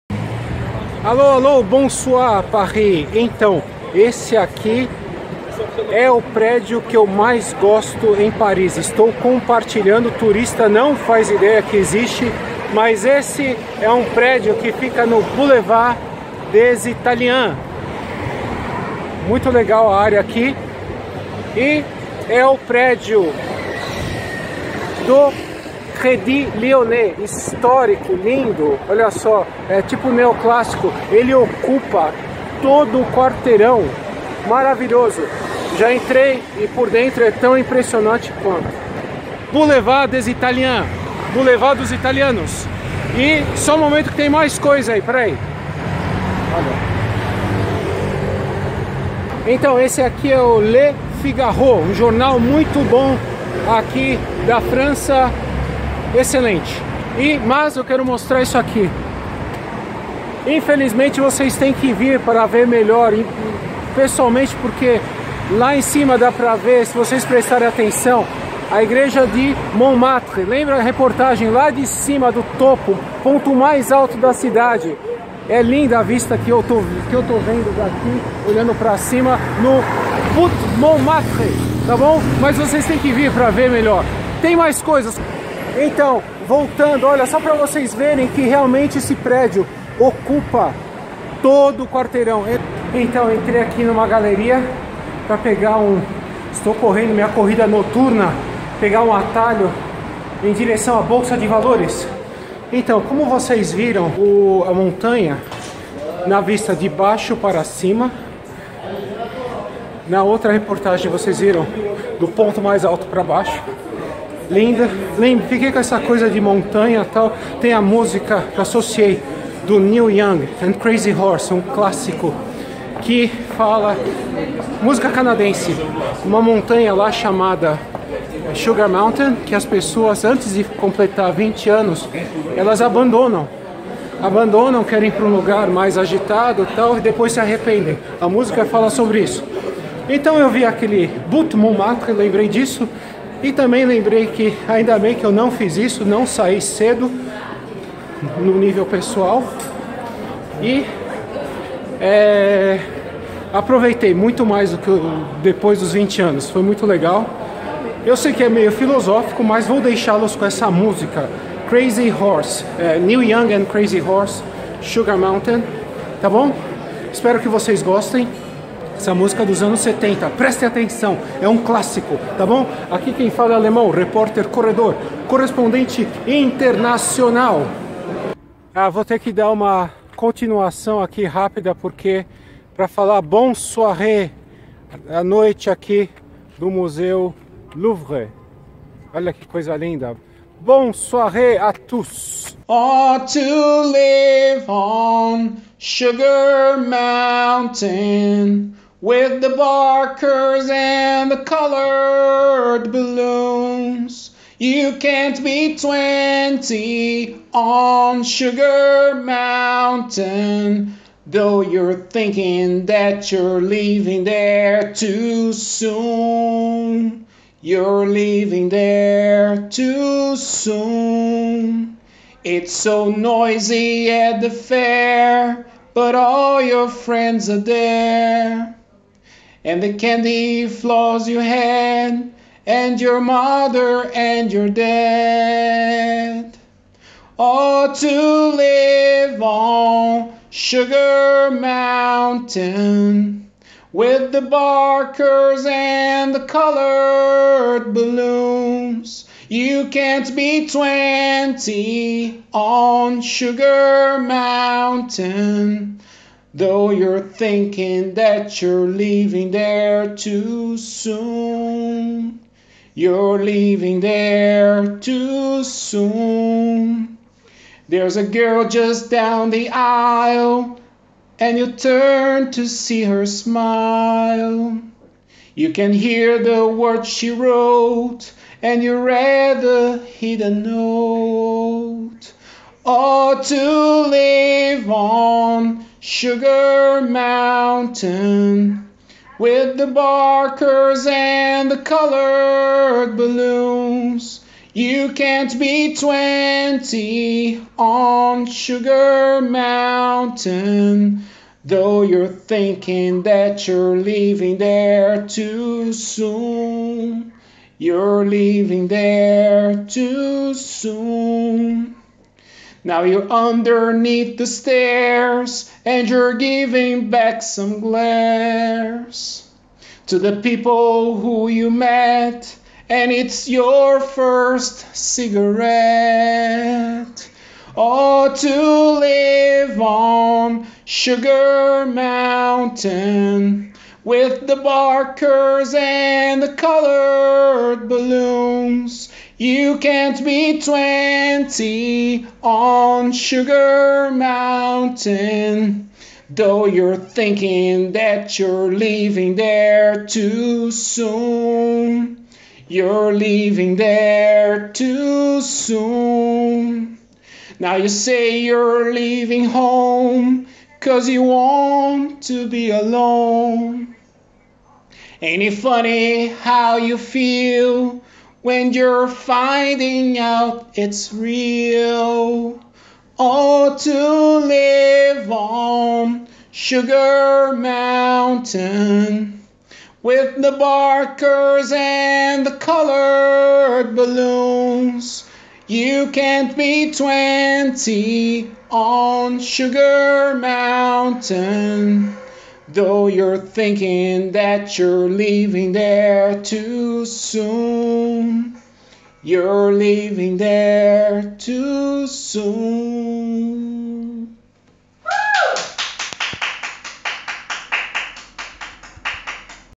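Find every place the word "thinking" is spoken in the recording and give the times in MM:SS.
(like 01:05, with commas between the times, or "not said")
03:31, 04:17, 05:02, 05:46, 06:33.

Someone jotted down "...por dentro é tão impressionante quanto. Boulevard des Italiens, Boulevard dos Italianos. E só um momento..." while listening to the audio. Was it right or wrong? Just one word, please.
right.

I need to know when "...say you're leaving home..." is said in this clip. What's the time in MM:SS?
05:57.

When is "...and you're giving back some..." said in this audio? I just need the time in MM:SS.
05:15.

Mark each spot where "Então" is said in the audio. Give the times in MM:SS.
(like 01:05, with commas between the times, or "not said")
00:03, 00:49, 01:25, 01:32, 01:42, 02:20.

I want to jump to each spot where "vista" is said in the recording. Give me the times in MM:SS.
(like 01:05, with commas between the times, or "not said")
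01:16, 01:46.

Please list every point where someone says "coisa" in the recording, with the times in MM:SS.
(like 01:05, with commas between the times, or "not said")
00:44, 01:24, 01:55, 03:09.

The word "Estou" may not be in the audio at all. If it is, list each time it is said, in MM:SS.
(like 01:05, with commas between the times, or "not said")
00:08, 01:36.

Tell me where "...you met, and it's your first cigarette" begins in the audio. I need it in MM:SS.
05:21.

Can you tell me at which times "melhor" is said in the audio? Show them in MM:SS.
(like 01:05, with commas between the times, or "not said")
01:02, 01:23.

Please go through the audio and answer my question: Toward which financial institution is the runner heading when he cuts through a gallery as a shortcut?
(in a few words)
Bolsa de Valores.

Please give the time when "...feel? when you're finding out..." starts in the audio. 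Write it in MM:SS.
06:06.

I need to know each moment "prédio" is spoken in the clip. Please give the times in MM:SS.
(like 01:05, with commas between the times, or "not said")
00:06, 00:14, 00:22, 01:29.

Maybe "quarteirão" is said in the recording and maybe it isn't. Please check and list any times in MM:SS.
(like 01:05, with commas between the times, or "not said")
00:33, 01:31.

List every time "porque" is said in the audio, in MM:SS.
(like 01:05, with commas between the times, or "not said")
01:04, 03:01.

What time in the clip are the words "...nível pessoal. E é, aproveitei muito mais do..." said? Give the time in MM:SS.
02:28.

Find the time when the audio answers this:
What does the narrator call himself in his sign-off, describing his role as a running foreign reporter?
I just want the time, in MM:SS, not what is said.
02:53.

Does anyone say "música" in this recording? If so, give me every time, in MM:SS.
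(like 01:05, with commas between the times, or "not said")
01:57, 02:04, 02:18, 02:40, 02:49.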